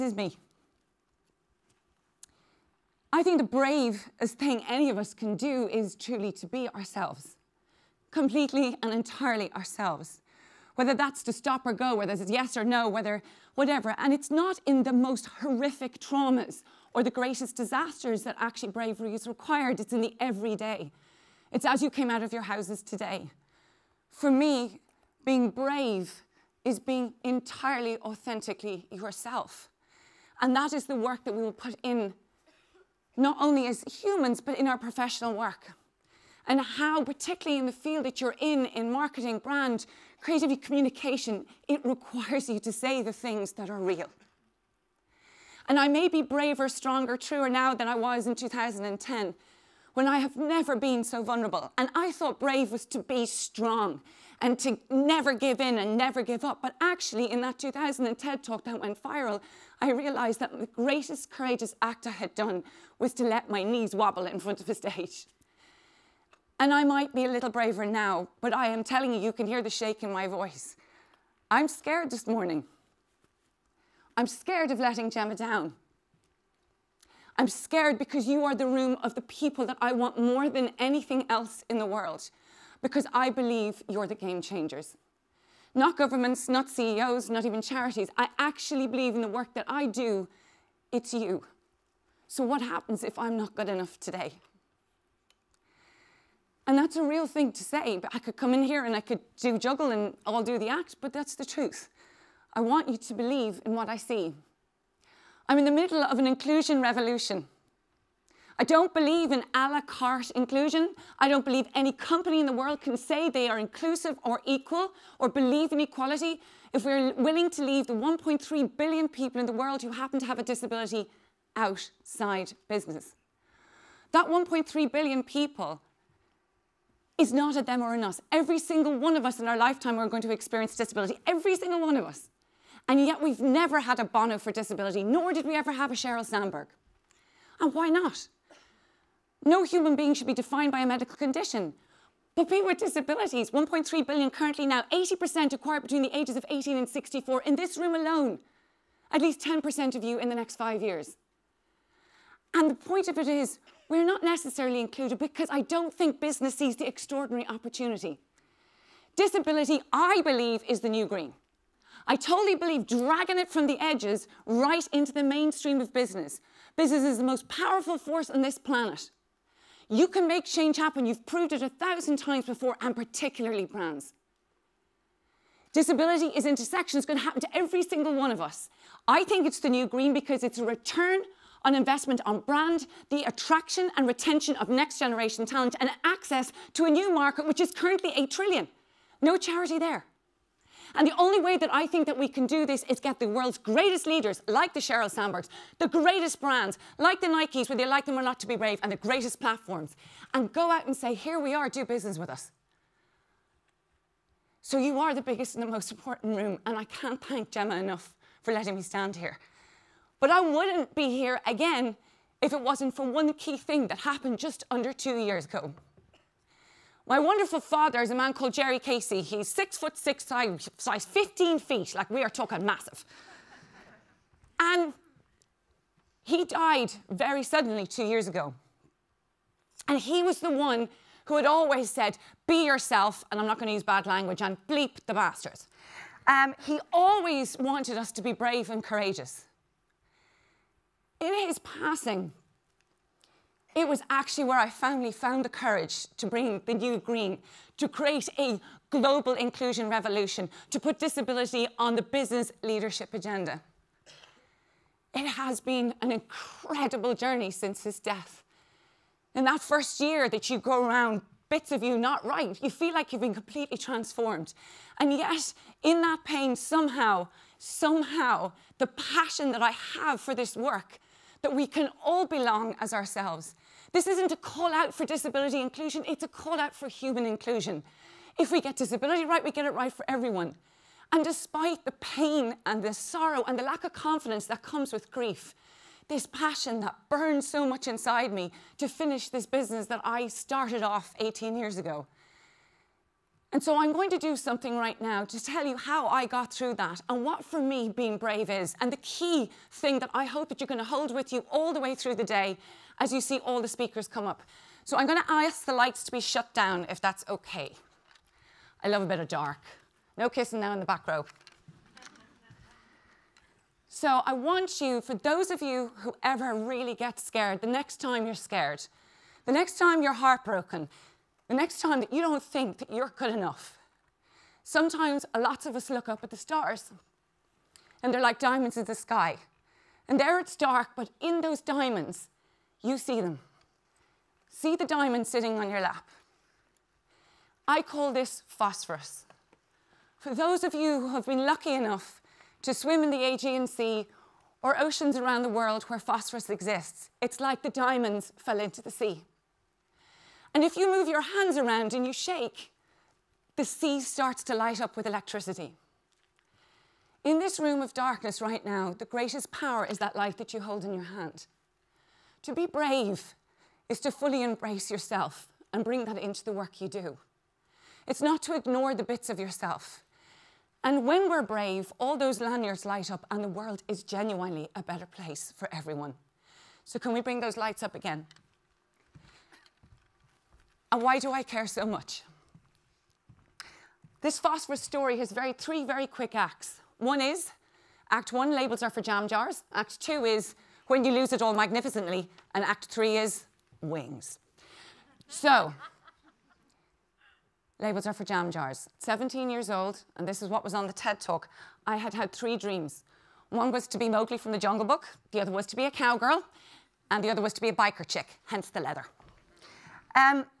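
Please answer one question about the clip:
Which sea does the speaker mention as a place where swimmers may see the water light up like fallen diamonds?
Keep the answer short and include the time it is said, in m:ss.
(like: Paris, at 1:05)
Aegean Sea, at 5:43.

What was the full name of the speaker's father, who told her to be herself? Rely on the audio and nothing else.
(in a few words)
Jerry Casey.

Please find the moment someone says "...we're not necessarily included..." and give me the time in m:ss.
2:33.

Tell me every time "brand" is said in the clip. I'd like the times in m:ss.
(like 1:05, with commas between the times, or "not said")
0:39, 2:53, 3:02, 3:16.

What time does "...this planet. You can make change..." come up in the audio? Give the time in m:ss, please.
2:48.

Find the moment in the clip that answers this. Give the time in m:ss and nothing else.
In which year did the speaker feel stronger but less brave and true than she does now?
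0:48.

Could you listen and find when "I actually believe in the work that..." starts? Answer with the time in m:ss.
1:28.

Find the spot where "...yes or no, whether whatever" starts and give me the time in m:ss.
0:12.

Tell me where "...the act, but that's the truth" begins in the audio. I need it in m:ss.
1:40.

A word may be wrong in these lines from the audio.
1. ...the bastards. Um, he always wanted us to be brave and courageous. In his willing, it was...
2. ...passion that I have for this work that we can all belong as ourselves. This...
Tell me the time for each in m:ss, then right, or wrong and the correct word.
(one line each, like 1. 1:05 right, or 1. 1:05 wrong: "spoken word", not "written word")
1. 3:55 wrong: "passing", not "willing"
2. 4:28 right.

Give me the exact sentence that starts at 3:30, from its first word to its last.
But I wouldn't be here again if it wasn't for one key thing that happened just under two years ago.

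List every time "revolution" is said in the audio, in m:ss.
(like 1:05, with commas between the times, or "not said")
1:46, 4:09.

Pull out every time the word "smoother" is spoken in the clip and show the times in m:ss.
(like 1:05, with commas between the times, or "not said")
not said.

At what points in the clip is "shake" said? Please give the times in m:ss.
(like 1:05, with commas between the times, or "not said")
1:09, 5:52.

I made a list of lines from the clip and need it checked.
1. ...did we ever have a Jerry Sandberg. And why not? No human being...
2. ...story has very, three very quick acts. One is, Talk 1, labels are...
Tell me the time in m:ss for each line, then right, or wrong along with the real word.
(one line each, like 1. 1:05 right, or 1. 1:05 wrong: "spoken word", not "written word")
1. 2:15 wrong: "Sheryl", not "Jerry"
2. 6:24 wrong: "Act", not "Talk".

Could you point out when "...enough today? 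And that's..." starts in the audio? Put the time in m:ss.
1:33.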